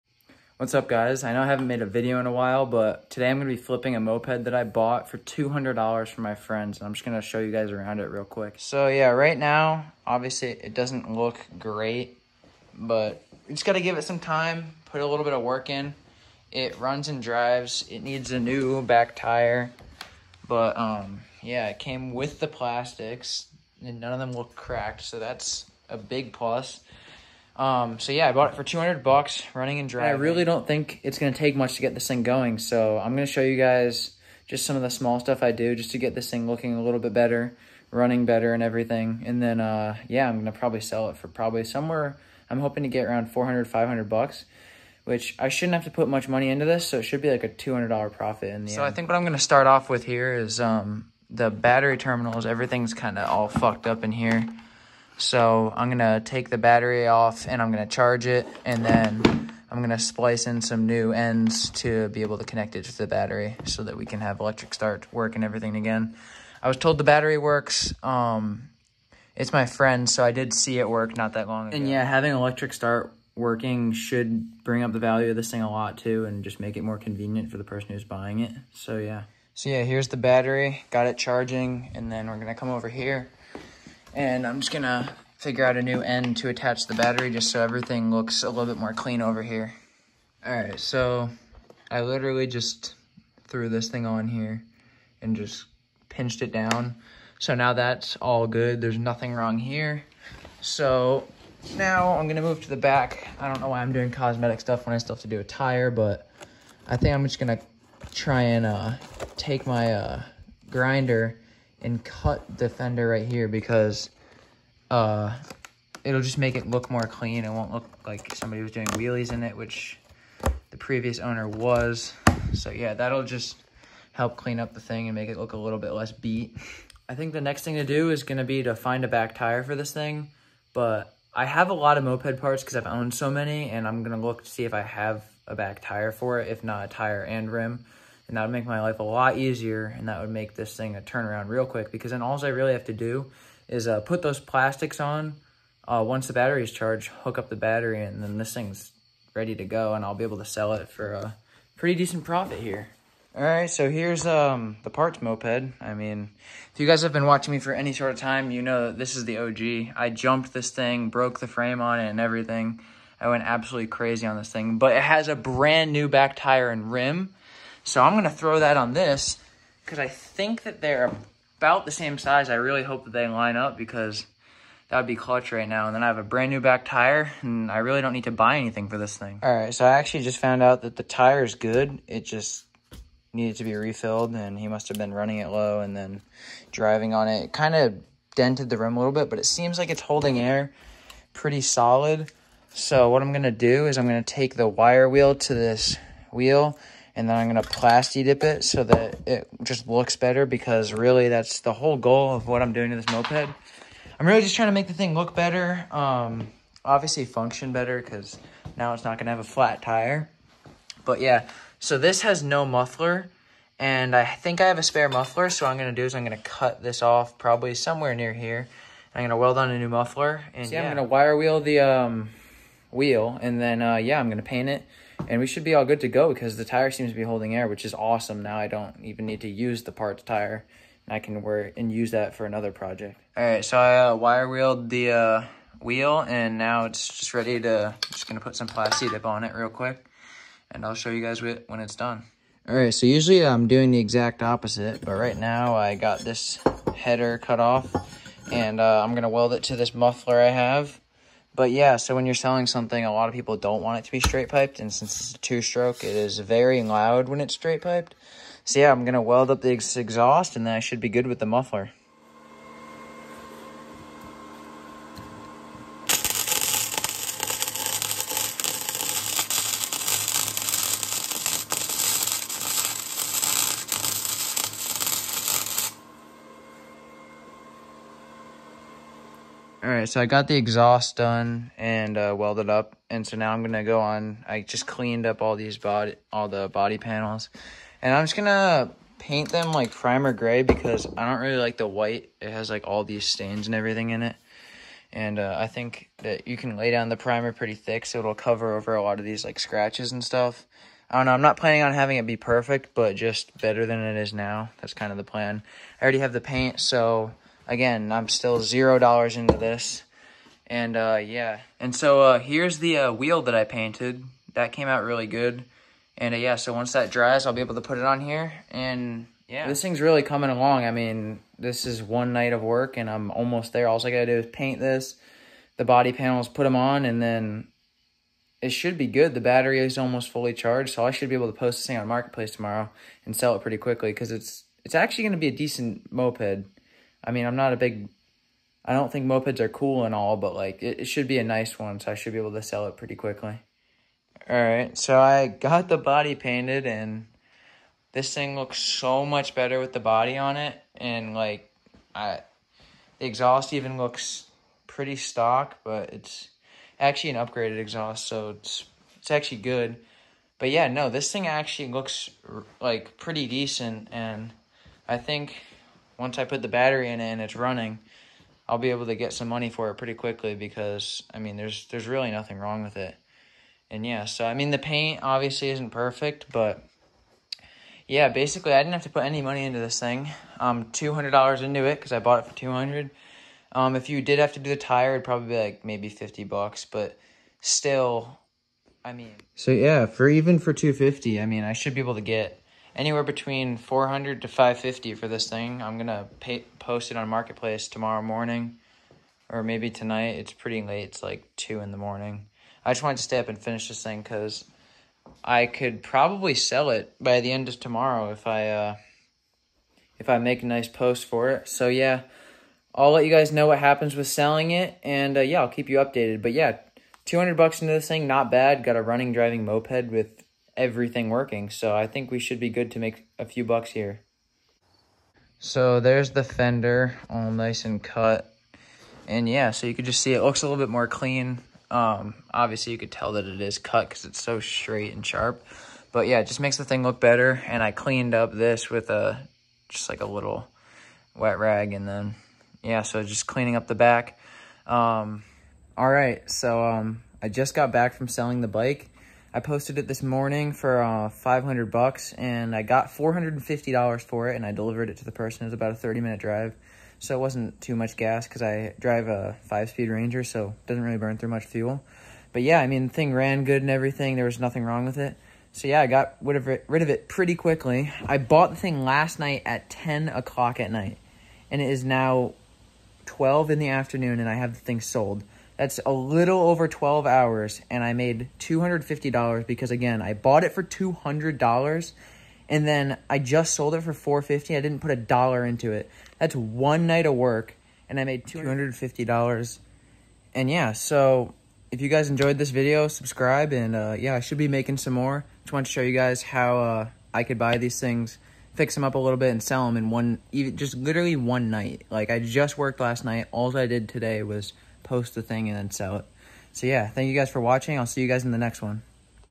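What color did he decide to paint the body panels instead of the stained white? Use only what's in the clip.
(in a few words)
primer gray.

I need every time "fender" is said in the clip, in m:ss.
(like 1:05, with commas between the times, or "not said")
1:52, 7:06.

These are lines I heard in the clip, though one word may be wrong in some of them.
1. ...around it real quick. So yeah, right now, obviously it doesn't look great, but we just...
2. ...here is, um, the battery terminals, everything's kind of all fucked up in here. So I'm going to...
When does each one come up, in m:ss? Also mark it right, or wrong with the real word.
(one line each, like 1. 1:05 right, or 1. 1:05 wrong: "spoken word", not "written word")
1. 0:07 right
2. 0:50 right.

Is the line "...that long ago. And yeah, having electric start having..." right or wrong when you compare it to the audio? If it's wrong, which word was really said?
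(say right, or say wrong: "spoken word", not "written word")
wrong: "working", not "having".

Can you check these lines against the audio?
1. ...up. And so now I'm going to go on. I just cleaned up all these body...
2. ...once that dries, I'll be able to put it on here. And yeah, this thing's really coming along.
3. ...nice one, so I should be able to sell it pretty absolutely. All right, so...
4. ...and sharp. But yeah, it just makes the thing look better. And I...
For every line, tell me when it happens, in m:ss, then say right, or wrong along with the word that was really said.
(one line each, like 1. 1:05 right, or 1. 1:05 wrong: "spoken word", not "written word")
1. 4:42 right
2. 5:16 right
3. 5:41 wrong: "quickly", not "absolutely"
4. 7:15 right.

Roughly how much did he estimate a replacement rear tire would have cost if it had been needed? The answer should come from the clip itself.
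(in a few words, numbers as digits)
$50.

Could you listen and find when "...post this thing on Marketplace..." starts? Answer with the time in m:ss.
5:31.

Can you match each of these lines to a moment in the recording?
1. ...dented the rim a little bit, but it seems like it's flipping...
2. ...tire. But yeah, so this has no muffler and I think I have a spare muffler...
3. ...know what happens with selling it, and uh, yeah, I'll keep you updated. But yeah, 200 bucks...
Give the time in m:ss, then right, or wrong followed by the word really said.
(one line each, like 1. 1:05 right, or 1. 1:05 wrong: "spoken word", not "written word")
1. 3:08 wrong: "holding", not "flipping"
2. 3:29 right
3. 6:53 right.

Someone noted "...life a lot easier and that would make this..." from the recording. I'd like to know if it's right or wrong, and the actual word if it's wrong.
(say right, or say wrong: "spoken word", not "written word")
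right.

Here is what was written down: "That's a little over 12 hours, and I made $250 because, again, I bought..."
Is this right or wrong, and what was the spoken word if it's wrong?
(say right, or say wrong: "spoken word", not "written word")
right.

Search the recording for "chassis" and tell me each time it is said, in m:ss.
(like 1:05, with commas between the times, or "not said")
not said.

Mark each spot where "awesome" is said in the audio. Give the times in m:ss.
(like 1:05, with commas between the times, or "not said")
3:47.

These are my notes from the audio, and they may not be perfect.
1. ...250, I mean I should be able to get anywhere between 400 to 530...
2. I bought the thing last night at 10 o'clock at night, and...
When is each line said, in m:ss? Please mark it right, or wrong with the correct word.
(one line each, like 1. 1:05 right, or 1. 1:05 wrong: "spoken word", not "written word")
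1. 6:30 wrong: "550", not "530"
2. 7:48 right.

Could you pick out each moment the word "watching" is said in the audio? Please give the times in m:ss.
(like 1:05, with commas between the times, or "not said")
2:37, 8:27.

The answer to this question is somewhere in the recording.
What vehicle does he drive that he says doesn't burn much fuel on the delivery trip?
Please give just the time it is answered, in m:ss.
7:39.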